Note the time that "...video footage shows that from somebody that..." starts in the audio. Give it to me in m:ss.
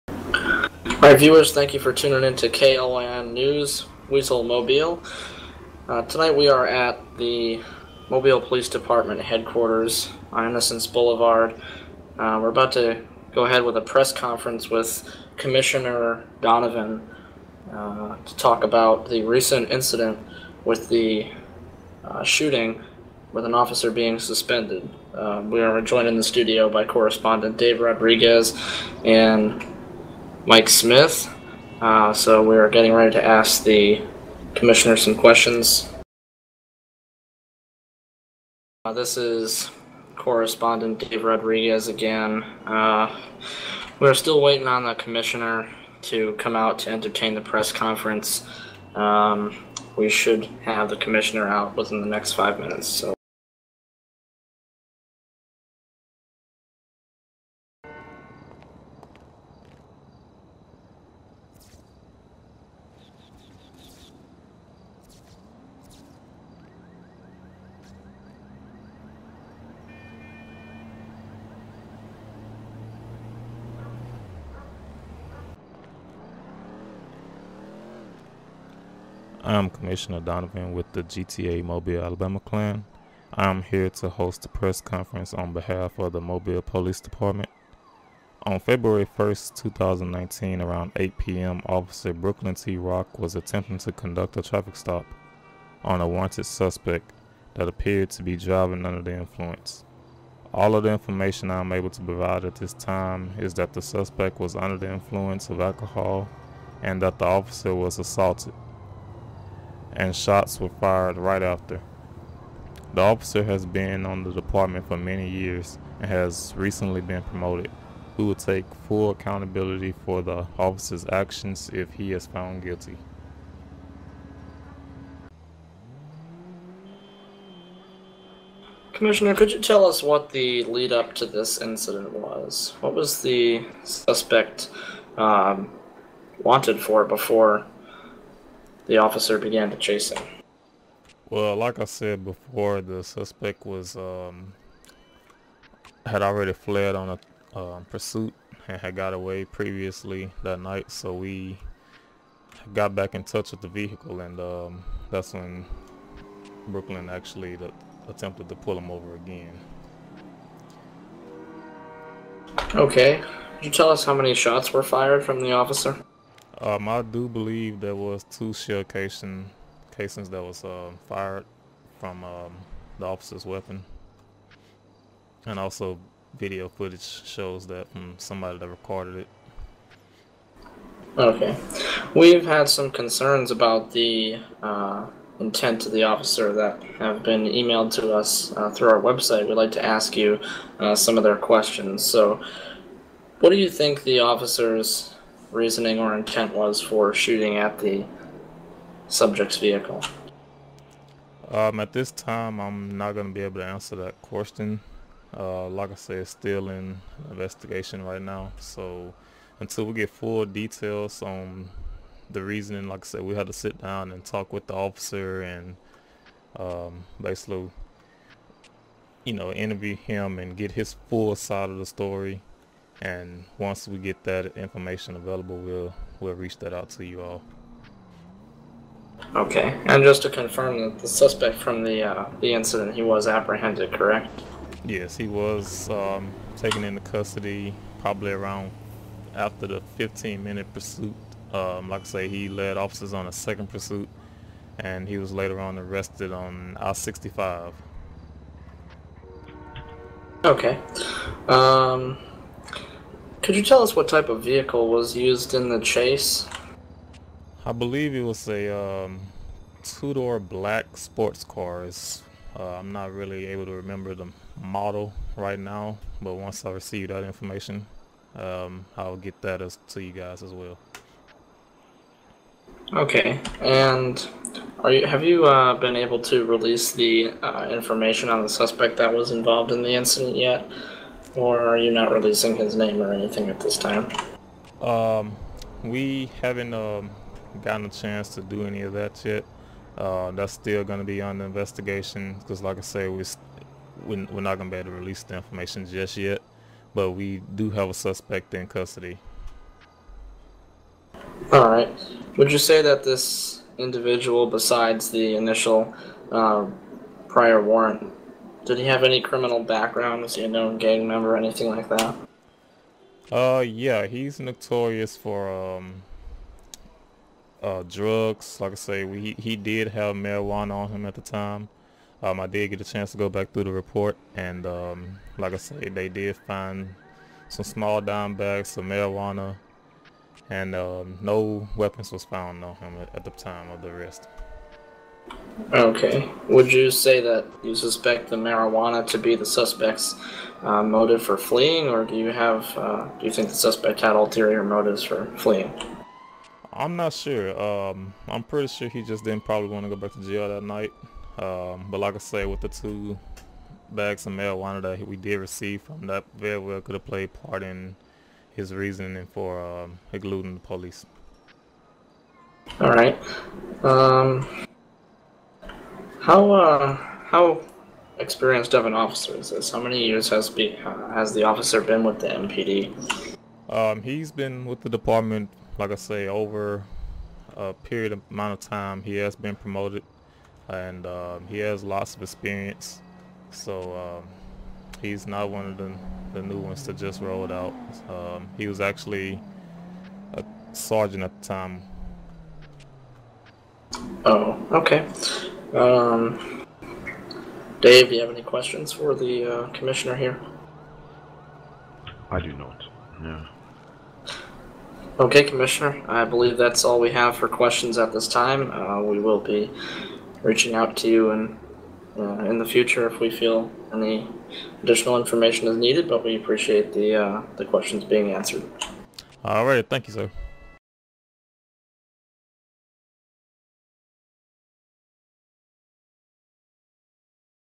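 2:56.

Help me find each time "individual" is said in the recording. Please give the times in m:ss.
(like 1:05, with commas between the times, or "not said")
5:03.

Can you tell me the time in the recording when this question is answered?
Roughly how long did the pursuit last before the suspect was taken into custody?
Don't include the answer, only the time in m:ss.
3:59.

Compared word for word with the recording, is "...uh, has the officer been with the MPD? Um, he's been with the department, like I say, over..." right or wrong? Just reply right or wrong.
right.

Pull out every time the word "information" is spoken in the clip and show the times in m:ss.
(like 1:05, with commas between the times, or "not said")
1:40, 3:44, 4:27, 4:37, 4:55, 6:55.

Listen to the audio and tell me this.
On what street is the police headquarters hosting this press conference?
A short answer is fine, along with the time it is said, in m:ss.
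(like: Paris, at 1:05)
Innocence Boulevard, at 0:10.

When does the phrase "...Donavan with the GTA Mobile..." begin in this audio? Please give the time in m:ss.
1:20.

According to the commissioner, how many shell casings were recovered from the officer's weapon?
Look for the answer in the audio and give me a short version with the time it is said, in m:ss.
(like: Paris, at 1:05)
2, at 2:48.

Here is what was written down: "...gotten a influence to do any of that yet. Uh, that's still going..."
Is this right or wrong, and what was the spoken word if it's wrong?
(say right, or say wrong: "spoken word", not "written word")
wrong: "chance", not "influence".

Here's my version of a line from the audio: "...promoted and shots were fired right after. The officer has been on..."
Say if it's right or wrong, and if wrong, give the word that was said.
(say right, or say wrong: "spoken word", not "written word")
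wrong: "assaulted", not "promoted".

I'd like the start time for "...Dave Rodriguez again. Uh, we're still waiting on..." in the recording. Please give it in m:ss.
0:41.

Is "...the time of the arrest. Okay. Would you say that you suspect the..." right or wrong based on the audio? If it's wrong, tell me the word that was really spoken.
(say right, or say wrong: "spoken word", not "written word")
right.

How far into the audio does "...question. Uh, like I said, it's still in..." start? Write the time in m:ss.
3:24.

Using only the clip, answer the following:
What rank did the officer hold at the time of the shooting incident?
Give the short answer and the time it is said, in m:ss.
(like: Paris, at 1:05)
Sergeant, at 6:30.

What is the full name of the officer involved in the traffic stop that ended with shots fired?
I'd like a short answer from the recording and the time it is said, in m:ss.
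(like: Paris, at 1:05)
Brooklyn T. Rock, at 1:32.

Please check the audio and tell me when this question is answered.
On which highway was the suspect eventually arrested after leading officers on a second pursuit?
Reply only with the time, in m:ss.
4:06.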